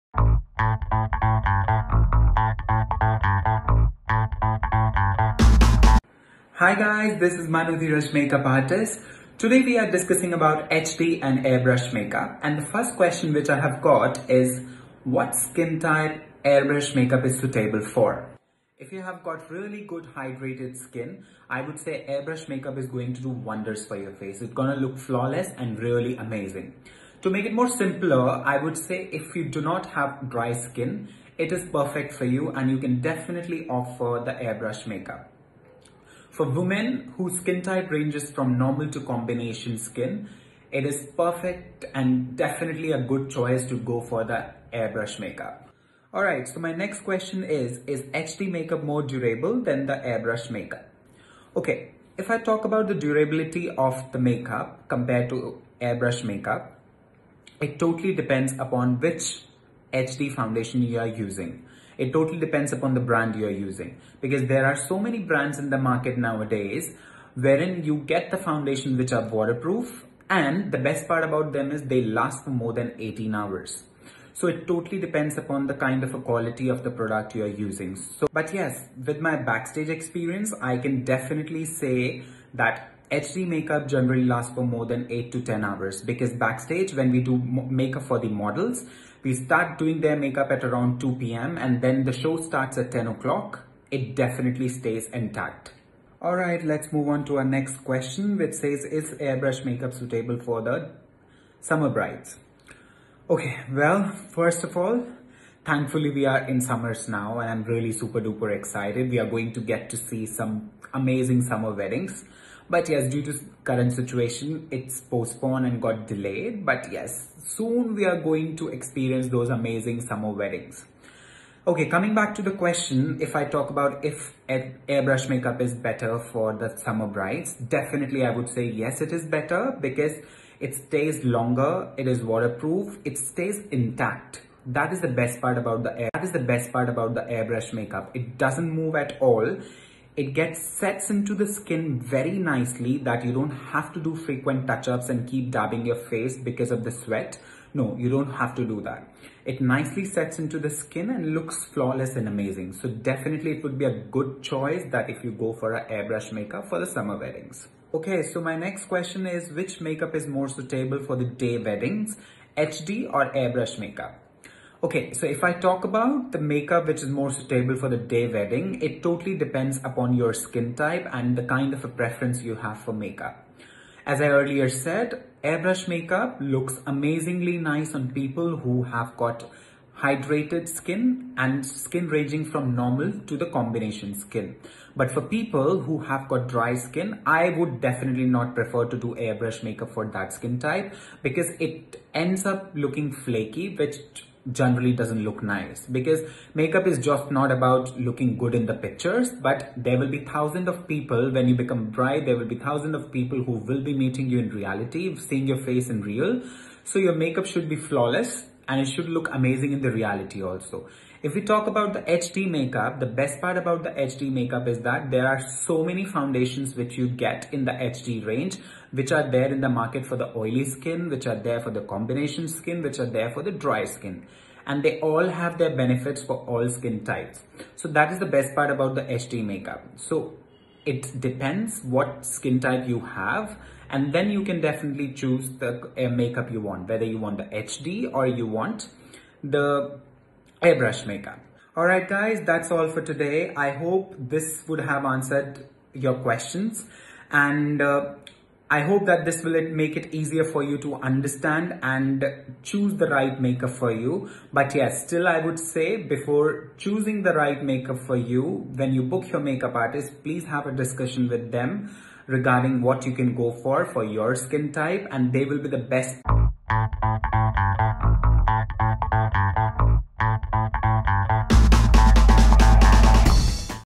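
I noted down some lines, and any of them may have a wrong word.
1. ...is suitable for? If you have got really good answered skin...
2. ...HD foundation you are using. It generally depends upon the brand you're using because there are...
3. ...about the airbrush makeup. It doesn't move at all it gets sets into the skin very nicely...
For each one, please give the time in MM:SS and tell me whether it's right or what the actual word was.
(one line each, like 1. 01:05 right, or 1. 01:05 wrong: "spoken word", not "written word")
1. 00:17 wrong: "hydrated", not "answered"
2. 00:59 wrong: "totally", not "generally"
3. 02:16 right.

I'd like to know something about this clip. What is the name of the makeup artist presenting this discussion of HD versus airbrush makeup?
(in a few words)
Manu Dheeraj.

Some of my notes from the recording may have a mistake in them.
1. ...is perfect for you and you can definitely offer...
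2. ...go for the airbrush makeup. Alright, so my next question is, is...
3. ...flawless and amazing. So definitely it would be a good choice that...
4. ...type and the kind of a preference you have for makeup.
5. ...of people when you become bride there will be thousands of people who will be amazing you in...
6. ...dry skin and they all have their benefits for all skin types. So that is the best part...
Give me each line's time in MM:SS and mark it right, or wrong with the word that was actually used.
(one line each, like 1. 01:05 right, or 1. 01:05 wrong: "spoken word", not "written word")
1. 00:31 right
2. 00:43 right
3. 02:31 right
4. 02:50 right
5. 03:20 wrong: "meeting", not "amazing"
6. 03:43 right.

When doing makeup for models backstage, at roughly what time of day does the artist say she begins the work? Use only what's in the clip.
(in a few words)
2 p.m.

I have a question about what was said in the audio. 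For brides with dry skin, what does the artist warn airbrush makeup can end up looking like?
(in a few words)
Flaky.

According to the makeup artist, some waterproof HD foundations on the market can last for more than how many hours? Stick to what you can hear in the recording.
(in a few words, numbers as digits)
18 hours.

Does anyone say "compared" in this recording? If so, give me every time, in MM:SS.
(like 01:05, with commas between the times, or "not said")
00:54.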